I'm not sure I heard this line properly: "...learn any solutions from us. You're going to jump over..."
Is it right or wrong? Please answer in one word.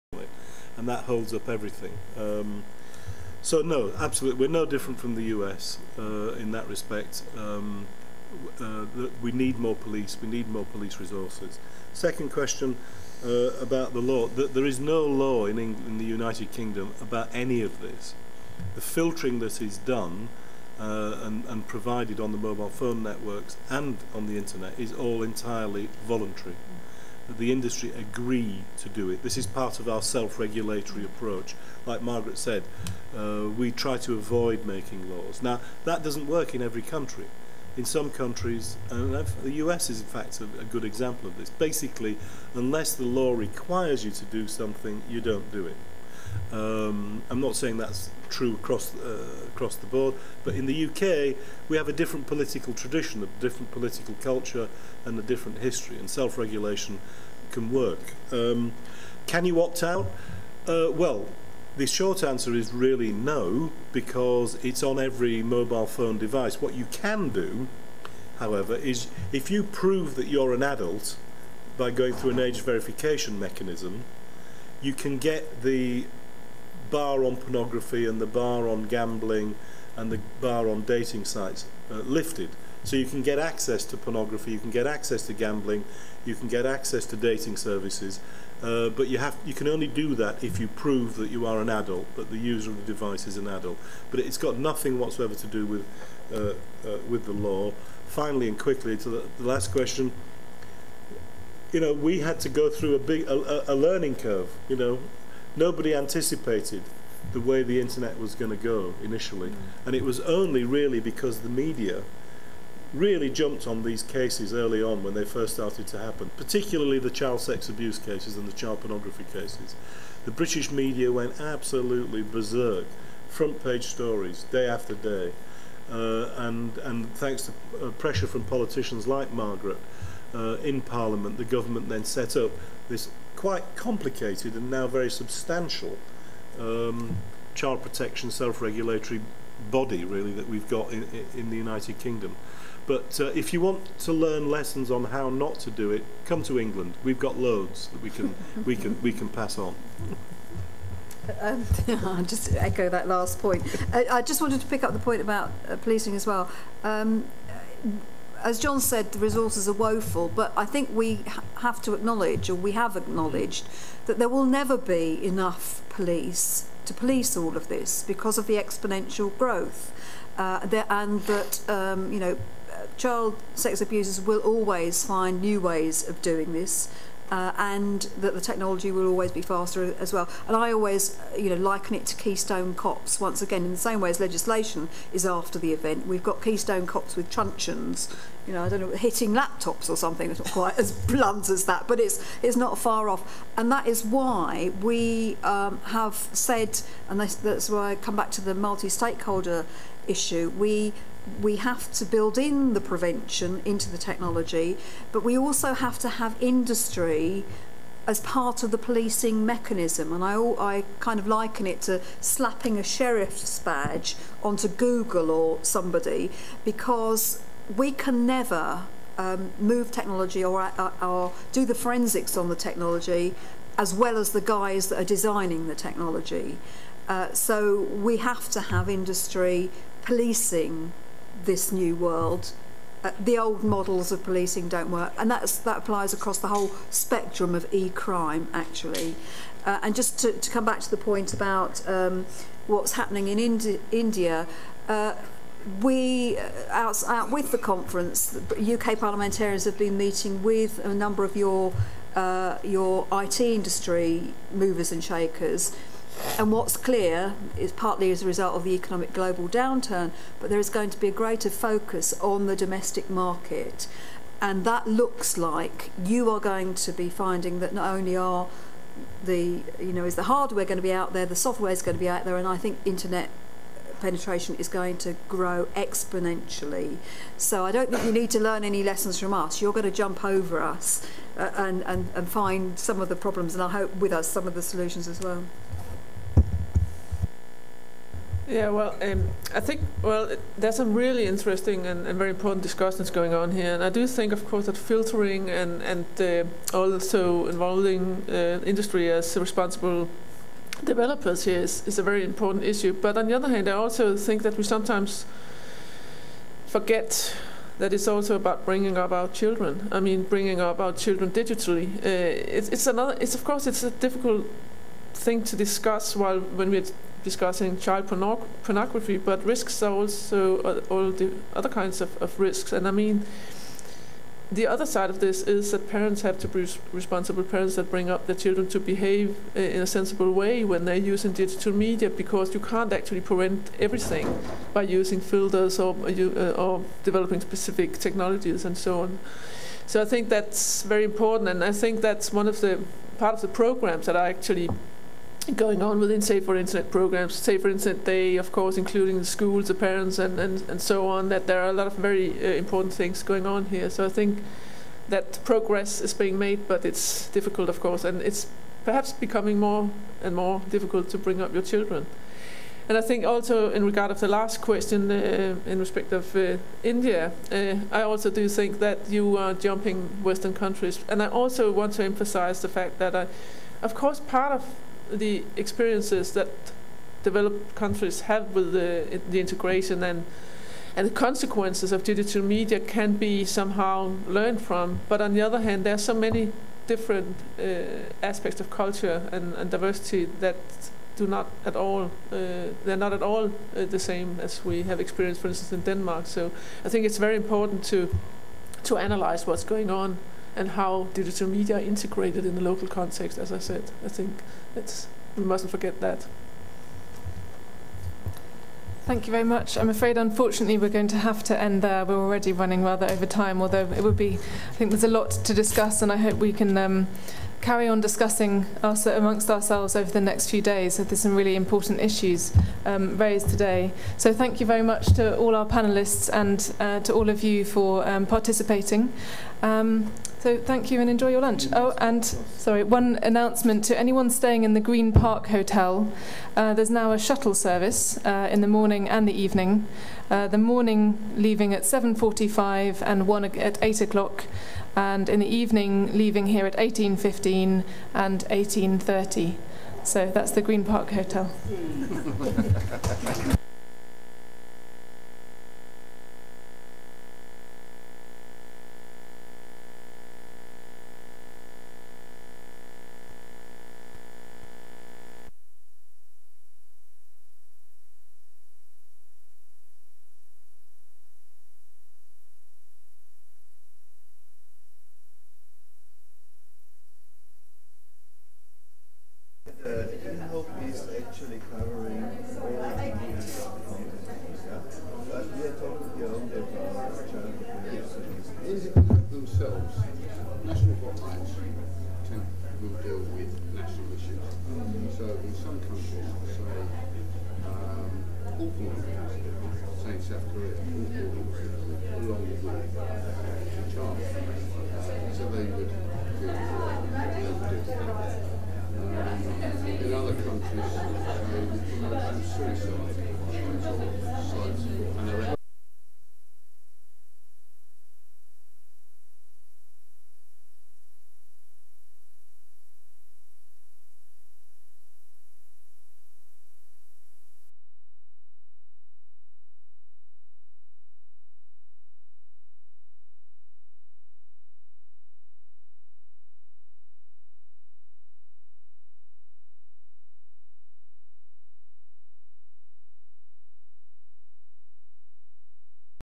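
wrong.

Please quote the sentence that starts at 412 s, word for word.
We're already running rather over time, although it would be, I think there's a lot to discuss, and I hope we can.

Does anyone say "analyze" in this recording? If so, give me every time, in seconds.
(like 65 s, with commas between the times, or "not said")
398 s.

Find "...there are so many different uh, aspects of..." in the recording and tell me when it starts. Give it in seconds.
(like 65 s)
385 s.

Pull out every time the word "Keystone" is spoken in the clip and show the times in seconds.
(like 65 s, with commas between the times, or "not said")
182 s, 186 s.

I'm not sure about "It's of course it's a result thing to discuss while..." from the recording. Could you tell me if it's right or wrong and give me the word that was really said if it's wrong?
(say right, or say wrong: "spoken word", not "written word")
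wrong: "difficult", not "result".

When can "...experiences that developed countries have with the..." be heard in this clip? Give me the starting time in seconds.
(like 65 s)
375 s.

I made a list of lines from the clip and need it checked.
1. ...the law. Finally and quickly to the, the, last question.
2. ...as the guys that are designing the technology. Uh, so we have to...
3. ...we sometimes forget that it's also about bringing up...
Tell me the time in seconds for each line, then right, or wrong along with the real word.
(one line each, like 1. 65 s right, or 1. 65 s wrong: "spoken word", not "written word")
1. 97 s right
2. 224 s right
3. 304 s right.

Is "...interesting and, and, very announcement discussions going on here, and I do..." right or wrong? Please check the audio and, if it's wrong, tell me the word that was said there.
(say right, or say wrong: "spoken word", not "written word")
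wrong: "important", not "announcement".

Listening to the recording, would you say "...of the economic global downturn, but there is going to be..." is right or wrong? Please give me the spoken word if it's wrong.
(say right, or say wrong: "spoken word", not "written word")
right.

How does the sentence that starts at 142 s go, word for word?
But uh, if you want to learn lessons on how not to do it, come to England.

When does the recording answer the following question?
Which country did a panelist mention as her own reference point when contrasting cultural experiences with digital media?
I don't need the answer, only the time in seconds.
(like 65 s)
395 s.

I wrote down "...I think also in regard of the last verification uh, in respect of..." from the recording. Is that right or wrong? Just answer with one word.
wrong.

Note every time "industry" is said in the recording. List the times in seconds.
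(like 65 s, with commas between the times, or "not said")
27 s, 206 s, 228 s, 253 s, 298 s.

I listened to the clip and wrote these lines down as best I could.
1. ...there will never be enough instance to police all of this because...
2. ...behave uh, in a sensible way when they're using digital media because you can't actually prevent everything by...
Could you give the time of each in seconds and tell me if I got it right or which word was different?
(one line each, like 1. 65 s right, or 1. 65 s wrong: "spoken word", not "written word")
1. 164 s wrong: "police", not "instance"
2. 328 s right.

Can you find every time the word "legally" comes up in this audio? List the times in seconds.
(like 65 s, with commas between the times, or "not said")
not said.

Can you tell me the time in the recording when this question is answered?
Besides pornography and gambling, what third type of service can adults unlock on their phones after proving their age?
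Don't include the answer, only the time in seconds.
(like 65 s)
80 s.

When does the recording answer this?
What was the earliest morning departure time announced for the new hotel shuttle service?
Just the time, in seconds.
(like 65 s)
441 s.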